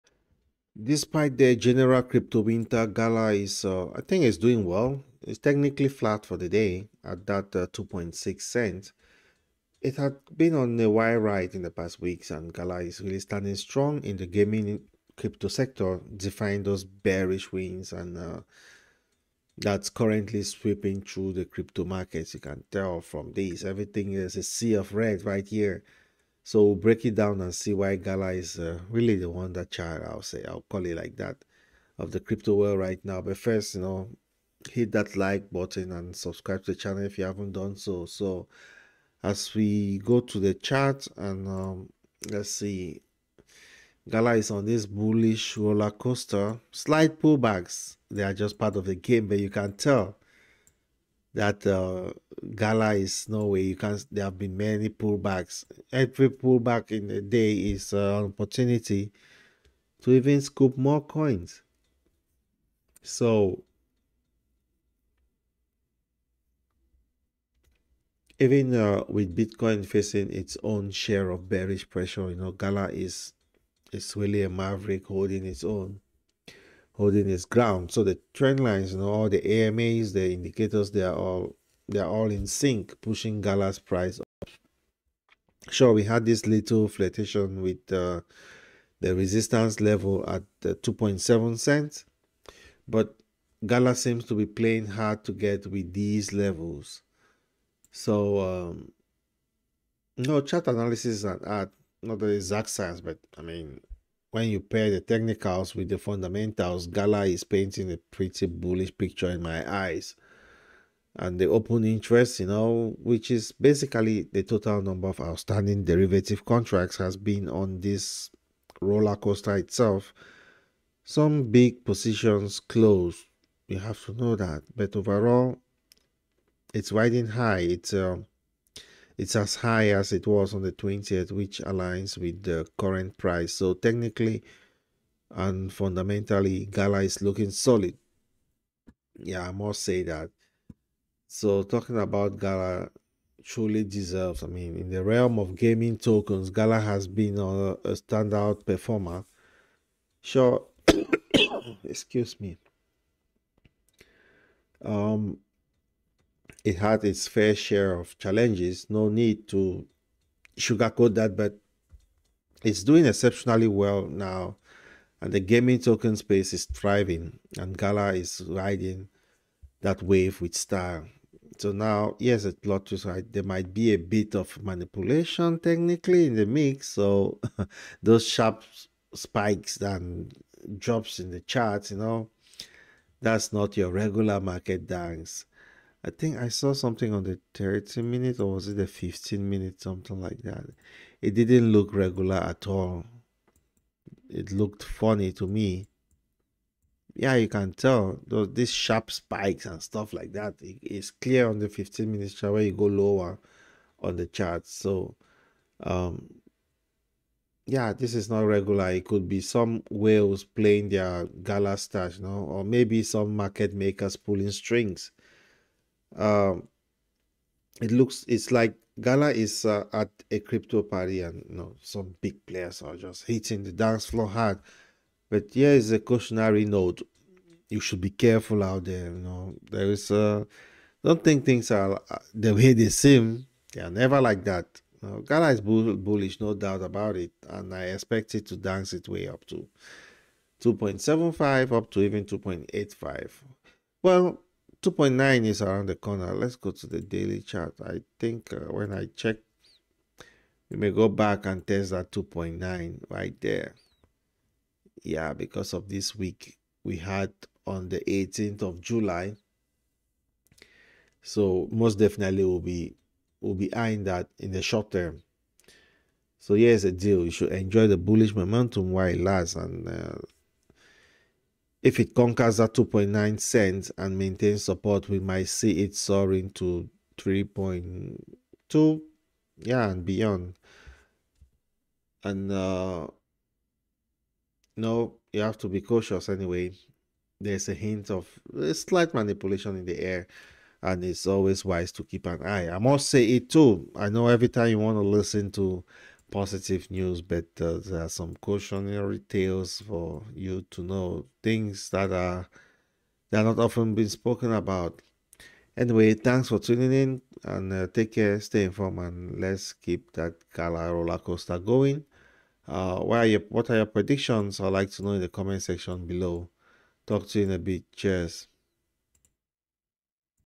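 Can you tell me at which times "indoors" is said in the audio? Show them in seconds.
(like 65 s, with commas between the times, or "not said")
not said.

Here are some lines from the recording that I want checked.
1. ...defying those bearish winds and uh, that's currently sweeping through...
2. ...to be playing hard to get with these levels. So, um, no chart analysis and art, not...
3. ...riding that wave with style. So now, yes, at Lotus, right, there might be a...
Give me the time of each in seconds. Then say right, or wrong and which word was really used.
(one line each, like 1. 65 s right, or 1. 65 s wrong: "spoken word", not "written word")
1. 16 s right
2. 94 s right
3. 168 s right.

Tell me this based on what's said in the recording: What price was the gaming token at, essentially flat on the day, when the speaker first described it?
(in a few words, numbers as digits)
2.6 cents.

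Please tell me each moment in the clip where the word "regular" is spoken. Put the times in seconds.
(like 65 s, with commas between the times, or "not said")
183 s, 191 s, 208 s.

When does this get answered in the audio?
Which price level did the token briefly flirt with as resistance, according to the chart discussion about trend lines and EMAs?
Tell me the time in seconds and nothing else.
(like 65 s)
90 s.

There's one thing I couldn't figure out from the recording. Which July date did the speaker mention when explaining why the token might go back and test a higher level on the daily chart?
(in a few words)
18th of July.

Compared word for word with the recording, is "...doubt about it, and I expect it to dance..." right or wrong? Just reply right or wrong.
right.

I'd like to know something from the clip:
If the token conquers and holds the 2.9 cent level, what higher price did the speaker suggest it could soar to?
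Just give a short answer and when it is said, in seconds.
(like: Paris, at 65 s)
3.2, at 277 s.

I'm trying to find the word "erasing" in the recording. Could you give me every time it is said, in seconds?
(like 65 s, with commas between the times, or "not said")
not said.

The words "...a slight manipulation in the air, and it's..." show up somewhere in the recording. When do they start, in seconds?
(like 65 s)
288 s.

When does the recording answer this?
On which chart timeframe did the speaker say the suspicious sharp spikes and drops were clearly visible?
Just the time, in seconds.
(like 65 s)
201 s.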